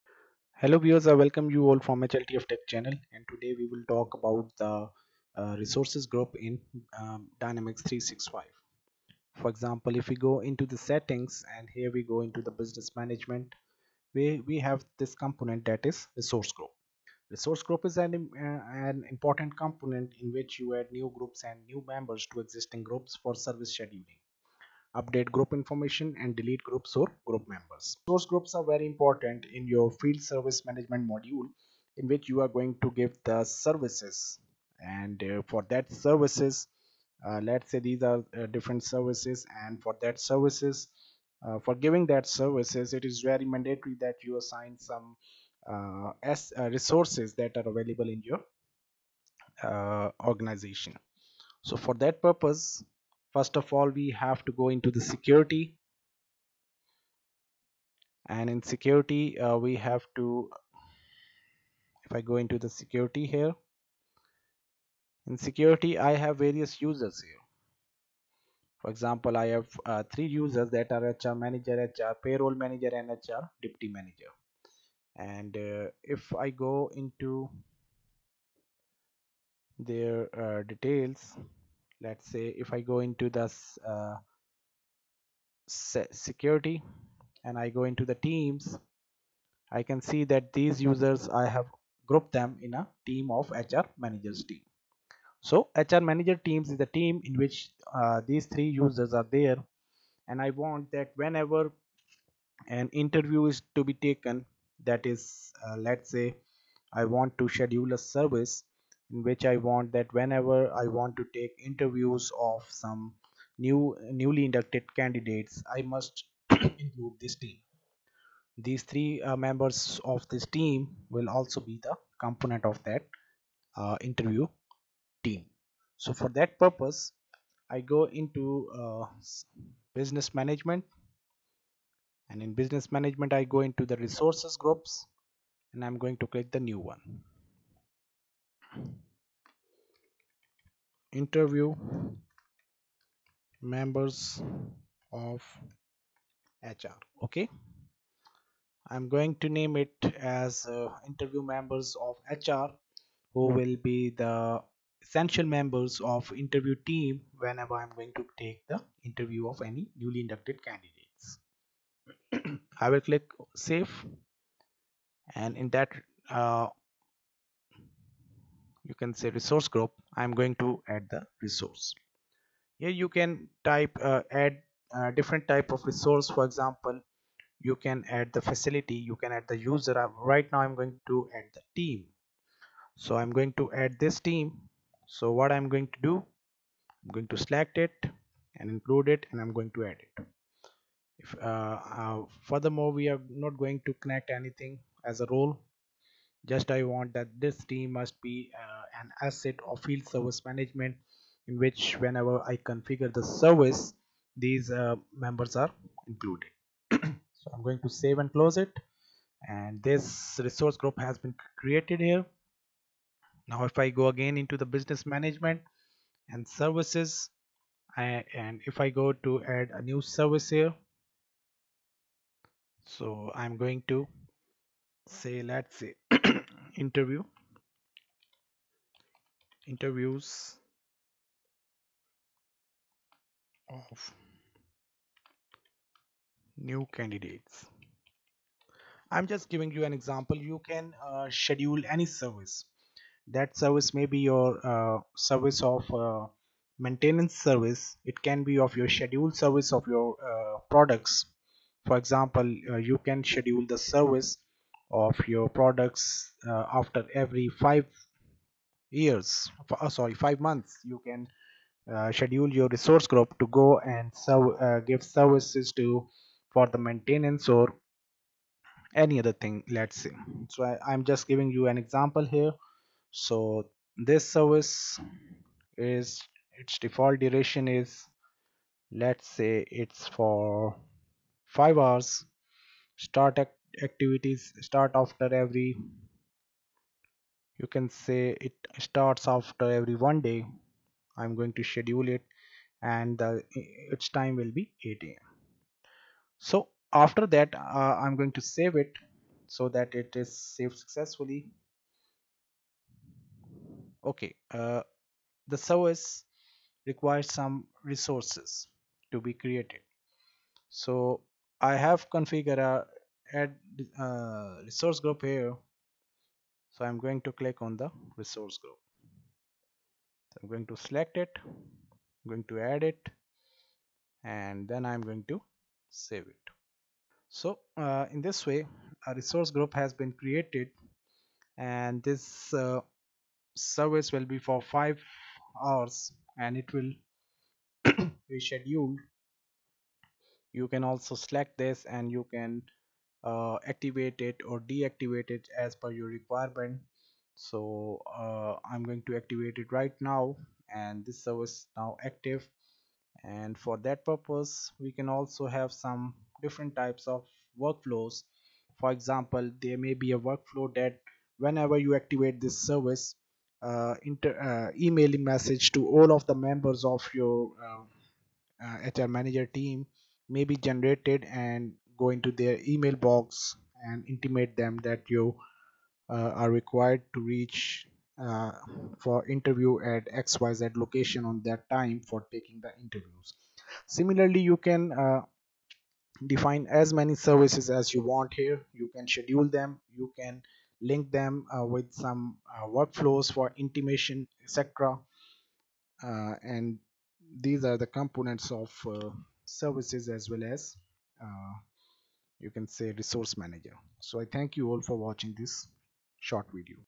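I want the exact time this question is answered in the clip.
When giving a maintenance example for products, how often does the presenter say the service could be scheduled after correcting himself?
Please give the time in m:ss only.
4:20.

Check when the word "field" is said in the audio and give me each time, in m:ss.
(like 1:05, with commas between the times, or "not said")
0:30, 3:19.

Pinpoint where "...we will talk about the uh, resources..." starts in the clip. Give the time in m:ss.
0:03.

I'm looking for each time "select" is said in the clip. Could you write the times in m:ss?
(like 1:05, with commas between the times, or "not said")
3:07, 5:20, 5:41.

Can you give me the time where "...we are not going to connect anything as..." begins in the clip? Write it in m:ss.
3:13.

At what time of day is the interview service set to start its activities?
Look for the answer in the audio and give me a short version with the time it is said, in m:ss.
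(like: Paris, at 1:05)
8 a.m., at 4:54.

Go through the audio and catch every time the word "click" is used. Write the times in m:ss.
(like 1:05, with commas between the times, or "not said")
2:16, 2:43, 5:17.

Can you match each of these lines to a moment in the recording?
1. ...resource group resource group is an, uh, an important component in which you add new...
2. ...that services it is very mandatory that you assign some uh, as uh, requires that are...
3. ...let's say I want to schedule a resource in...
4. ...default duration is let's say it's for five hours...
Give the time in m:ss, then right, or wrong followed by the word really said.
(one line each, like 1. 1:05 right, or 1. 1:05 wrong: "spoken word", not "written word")
1. 0:16 right
2. 0:42 wrong: "resources", not "requires"
3. 1:45 wrong: "service", not "resource"
4. 4:36 right.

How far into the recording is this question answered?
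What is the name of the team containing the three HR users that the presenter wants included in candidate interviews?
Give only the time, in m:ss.
1:33.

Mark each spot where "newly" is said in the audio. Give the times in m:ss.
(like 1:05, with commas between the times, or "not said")
1:54, 2:39.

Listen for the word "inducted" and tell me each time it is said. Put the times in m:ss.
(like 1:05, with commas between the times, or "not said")
1:54, 2:40.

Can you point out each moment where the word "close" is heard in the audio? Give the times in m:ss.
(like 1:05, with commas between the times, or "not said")
3:28.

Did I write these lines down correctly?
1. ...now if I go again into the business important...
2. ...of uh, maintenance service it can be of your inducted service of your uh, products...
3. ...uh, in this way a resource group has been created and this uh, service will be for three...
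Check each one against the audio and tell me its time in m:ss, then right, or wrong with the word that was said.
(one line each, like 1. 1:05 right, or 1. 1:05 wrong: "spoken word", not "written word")
1. 3:33 wrong: "management", not "important"
2. 4:05 wrong: "scheduled", not "inducted"
3. 5:27 wrong: "five", not "three".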